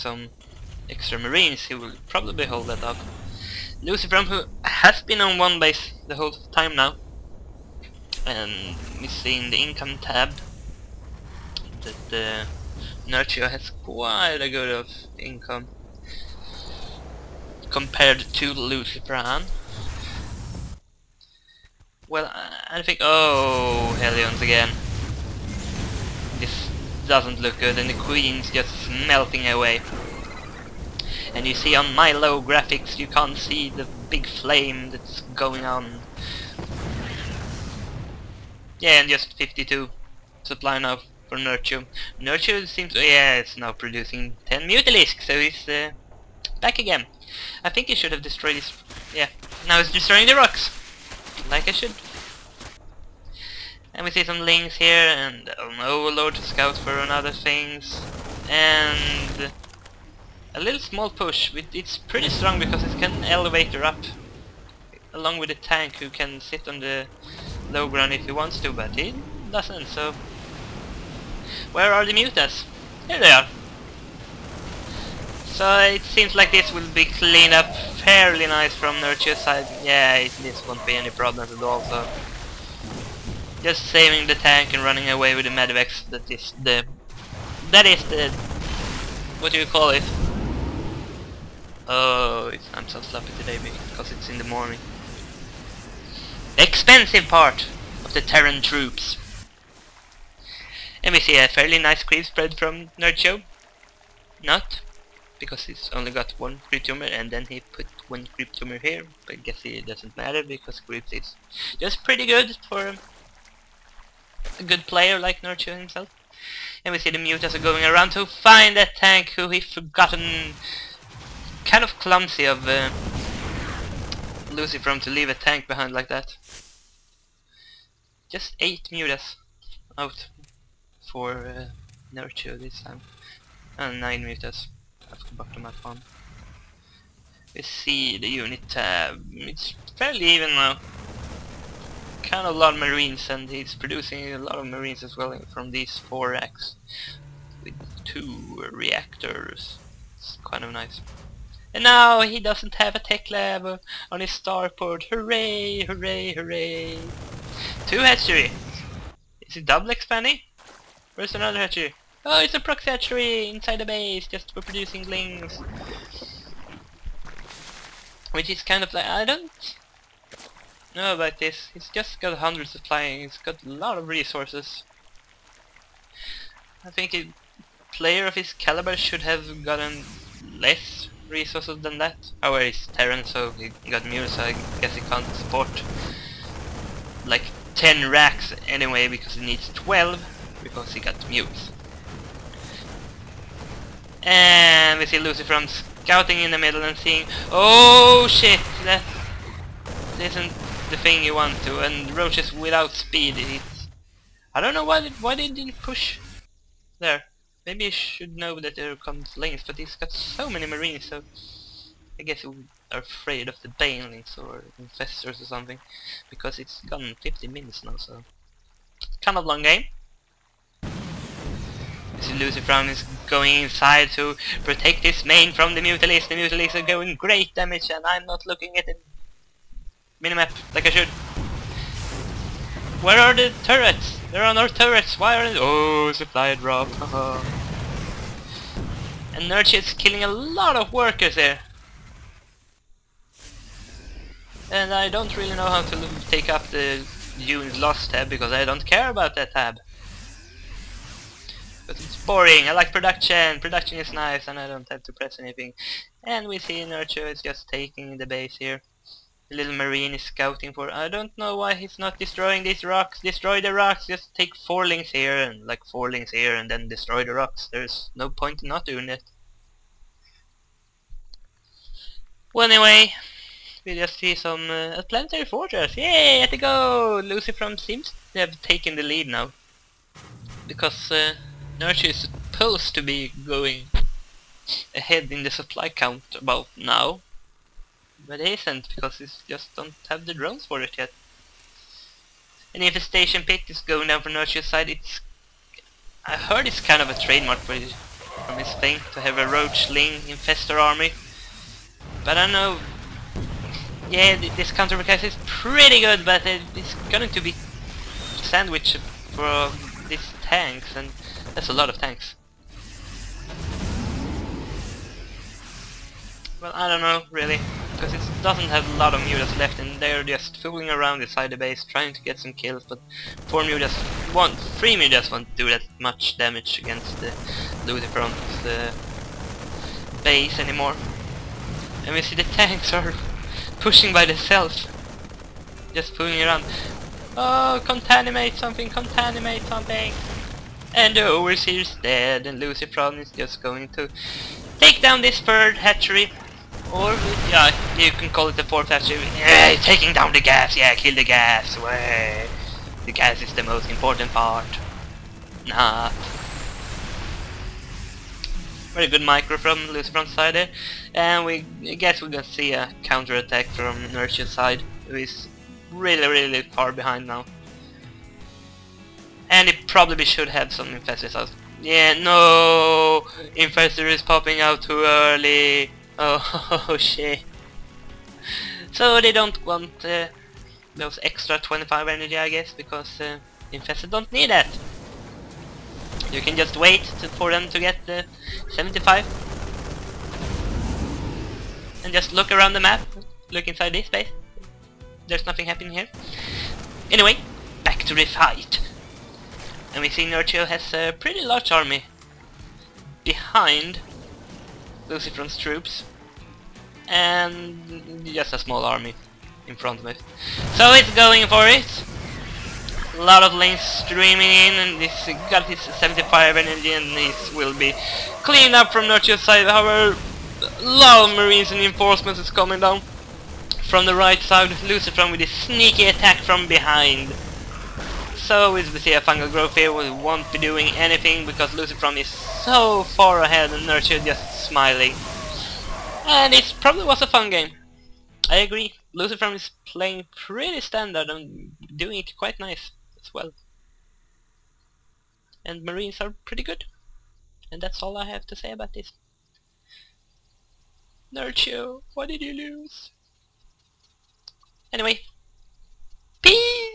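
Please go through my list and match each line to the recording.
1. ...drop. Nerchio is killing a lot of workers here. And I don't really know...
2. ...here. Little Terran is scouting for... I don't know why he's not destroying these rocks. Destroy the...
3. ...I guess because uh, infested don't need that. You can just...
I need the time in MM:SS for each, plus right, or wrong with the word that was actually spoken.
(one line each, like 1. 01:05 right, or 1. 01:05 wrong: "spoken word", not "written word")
1. 03:56 right
2. 04:18 wrong: "Marine", not "Terran"
3. 06:22 right.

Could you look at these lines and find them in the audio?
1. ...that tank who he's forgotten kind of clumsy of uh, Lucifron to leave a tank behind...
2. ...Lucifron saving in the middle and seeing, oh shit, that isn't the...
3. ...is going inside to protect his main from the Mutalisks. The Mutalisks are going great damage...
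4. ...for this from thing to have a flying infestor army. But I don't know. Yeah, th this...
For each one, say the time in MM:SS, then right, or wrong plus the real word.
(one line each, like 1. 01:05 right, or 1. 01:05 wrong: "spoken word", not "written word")
1. 01:58 right
2. 03:15 wrong: "scouting", not "saving"
3. 03:42 right
4. 04:57 wrong: "roachling", not "flying".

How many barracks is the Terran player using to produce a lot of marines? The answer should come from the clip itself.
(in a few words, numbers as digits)
4.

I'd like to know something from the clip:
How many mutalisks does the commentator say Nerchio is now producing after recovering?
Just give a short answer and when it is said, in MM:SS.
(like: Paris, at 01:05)
10, at 00:44.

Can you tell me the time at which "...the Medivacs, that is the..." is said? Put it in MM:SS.
01:25.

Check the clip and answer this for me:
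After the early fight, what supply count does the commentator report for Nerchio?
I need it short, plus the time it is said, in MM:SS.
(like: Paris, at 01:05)
52, at 00:39.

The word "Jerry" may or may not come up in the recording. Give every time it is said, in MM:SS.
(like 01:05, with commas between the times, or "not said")
not said.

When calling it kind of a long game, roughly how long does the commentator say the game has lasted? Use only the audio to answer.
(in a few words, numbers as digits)
50 minutes.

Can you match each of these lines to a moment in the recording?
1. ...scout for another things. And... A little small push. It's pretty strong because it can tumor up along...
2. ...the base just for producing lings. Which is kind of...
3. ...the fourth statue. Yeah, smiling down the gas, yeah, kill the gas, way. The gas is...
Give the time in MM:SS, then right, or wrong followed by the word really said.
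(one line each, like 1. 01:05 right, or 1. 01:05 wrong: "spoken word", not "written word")
1. 00:56 wrong: "elevator", not "tumor"
2. 02:43 right
3. 05:48 wrong: "taking", not "smiling".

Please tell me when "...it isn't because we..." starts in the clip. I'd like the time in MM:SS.
04:48.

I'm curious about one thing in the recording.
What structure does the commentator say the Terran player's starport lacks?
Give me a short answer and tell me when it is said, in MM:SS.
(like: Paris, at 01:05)
tech lab, at 02:32.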